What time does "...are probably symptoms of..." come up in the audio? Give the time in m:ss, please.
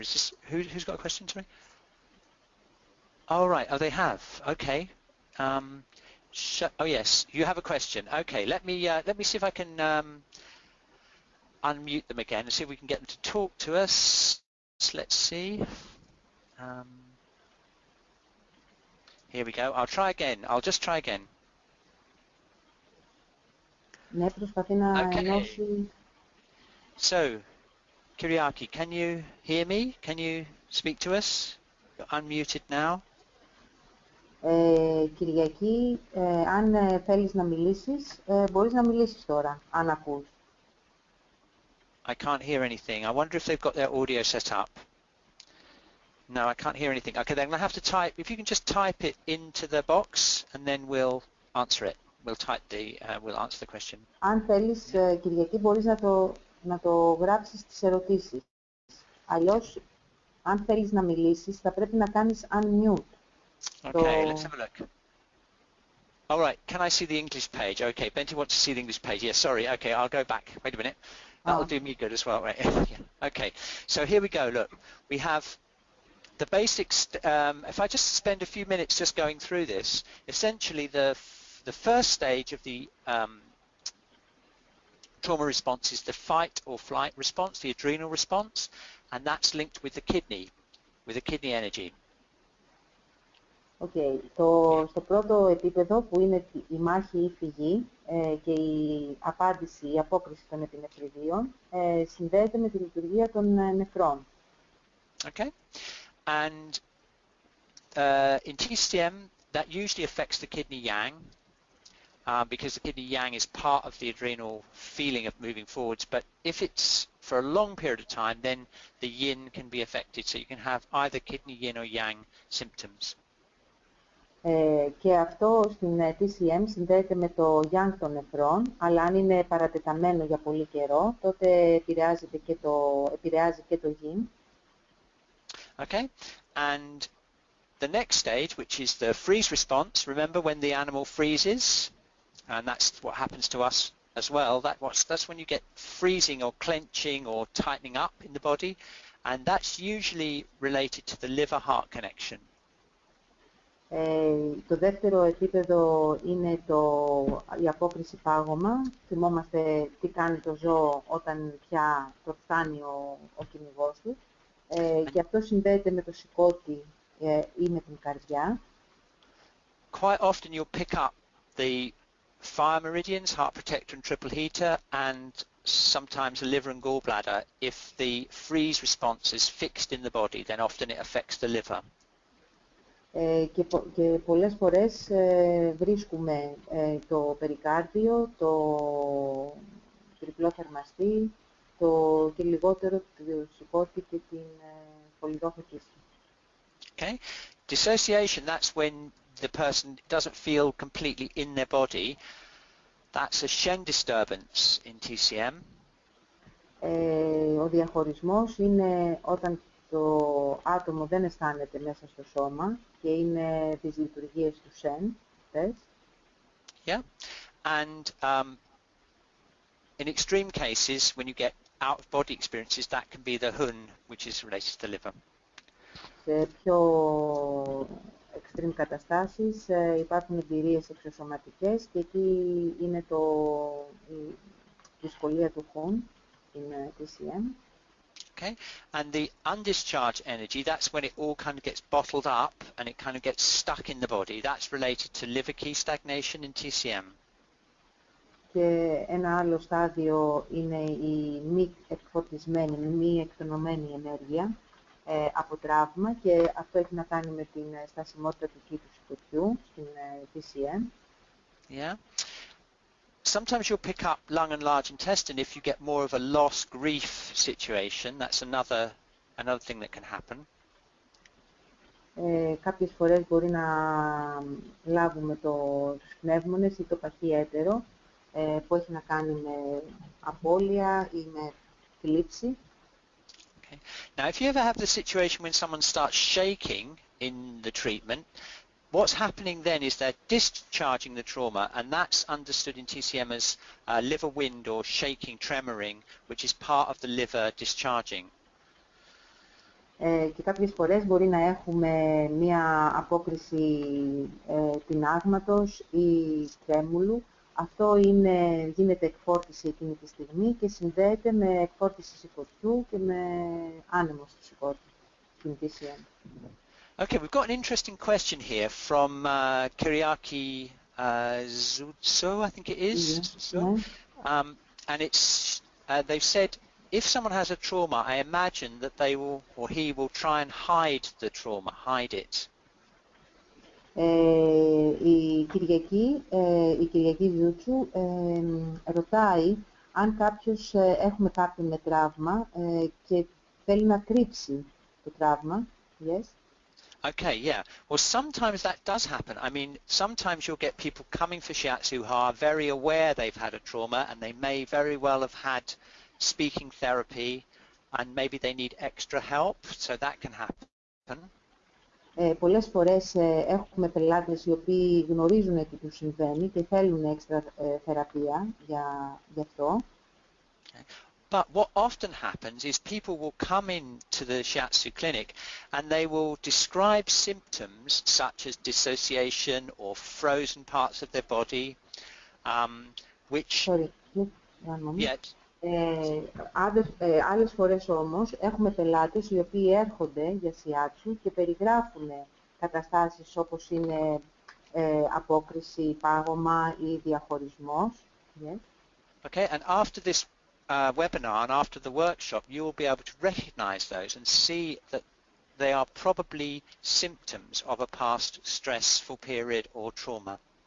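6:45.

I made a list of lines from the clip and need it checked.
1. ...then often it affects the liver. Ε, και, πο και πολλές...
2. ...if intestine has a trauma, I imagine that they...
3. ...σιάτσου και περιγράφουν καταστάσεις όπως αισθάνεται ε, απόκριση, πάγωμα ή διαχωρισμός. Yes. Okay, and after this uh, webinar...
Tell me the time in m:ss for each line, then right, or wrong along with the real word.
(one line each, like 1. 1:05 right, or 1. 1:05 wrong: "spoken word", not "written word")
1. 3:00 right
2. 5:26 wrong: "someone", not "intestine"
3. 6:30 wrong: "είναι", not "αισθάνεται".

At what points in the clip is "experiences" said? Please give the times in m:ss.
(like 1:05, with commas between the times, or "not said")
3:42.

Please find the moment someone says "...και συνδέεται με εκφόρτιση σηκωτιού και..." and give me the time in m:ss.
5:10.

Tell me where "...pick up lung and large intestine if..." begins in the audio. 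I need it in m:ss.
4:23.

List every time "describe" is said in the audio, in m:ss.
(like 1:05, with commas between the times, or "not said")
6:16.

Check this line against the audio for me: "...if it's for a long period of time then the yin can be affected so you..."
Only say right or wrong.
right.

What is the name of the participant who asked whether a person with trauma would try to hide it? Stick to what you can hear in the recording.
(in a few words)
Zutso.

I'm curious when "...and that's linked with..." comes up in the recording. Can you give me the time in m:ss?
1:29.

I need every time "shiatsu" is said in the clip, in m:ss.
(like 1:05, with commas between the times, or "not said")
5:51, 6:14.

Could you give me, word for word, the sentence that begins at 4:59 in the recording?
Ε, και κάποιες φορές μπορεί να έχουμε μία απόκριση ε, τυνάγματος ή τρέμουλου.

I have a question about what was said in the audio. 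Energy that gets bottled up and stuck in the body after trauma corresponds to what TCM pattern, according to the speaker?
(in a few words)
Liver Ki stagnation.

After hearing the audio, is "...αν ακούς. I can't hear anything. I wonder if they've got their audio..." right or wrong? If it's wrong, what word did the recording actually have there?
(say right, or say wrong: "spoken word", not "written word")
right.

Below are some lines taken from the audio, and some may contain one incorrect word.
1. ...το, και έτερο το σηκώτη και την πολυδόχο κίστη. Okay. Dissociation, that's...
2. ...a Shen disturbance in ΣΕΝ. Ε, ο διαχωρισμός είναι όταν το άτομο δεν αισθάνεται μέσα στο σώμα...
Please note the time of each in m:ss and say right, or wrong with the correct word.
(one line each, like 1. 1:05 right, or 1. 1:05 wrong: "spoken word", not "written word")
1. 3:11 wrong: "λιγότερο", not "έτερο"
2. 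3:23 wrong: "TCM", not "ΣΕΝ".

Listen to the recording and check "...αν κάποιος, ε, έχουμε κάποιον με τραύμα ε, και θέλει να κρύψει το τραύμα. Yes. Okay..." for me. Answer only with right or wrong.
right.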